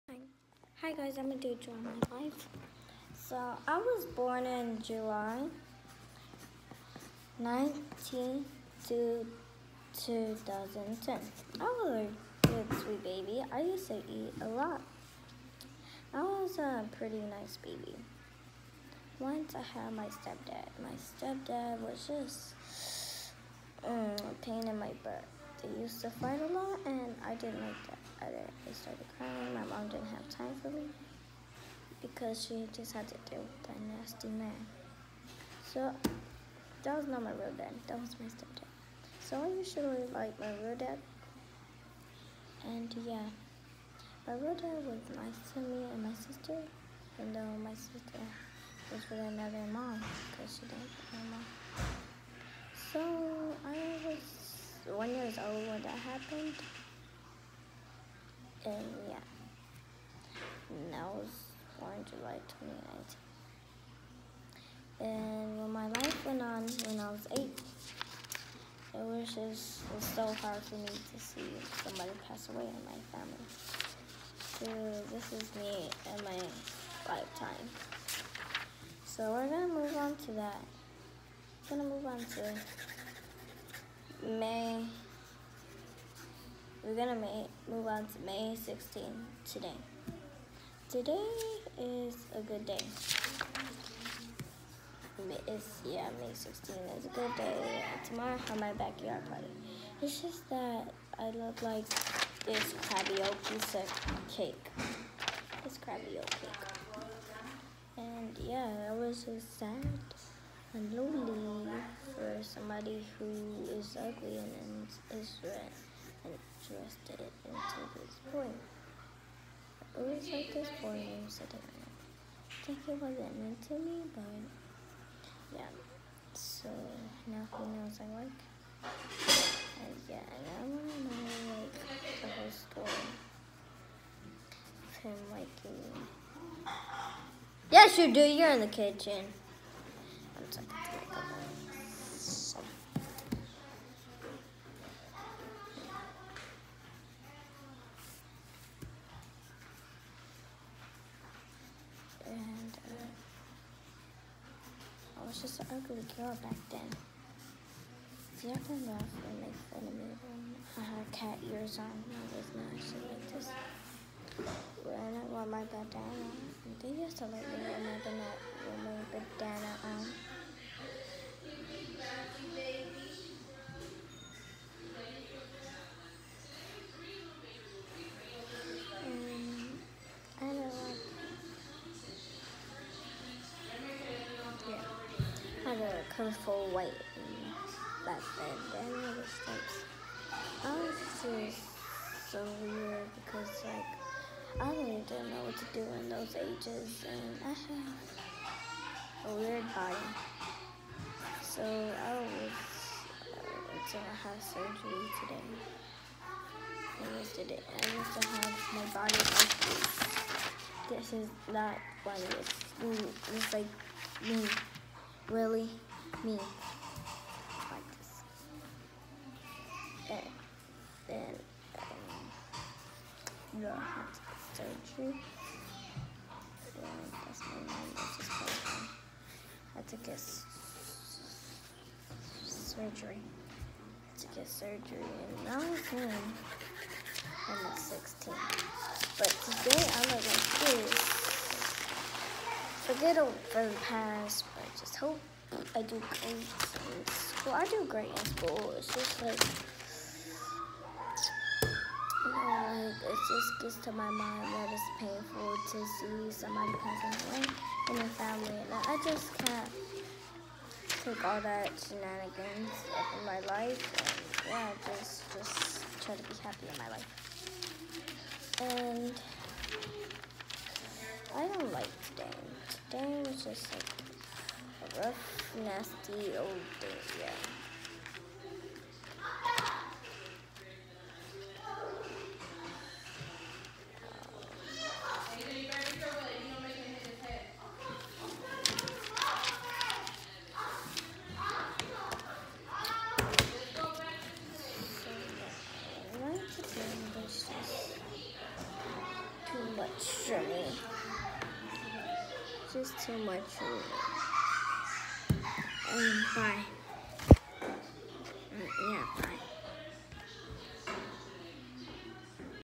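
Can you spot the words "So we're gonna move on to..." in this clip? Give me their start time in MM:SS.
01:19.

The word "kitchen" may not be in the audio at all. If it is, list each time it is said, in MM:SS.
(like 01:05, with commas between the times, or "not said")
02:18.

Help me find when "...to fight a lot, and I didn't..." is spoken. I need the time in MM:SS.
00:26.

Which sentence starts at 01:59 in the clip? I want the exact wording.
I always like this poem, said the man.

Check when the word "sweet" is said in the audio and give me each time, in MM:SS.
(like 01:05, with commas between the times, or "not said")
00:12.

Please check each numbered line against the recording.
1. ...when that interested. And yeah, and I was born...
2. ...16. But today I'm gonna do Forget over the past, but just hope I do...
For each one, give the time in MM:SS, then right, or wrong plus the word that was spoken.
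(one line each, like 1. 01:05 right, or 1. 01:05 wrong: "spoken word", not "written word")
1. 00:55 wrong: "happened", not "interested"
2. 03:57 right.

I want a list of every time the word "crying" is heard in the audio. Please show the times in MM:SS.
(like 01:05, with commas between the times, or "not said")
00:29.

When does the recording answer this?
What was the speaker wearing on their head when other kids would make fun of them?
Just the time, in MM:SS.
02:41.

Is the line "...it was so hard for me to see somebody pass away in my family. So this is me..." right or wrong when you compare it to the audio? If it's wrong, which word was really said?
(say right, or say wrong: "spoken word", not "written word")
right.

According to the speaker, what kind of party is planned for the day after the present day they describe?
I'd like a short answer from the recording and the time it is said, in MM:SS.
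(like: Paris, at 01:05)
backyard party, at 01:38.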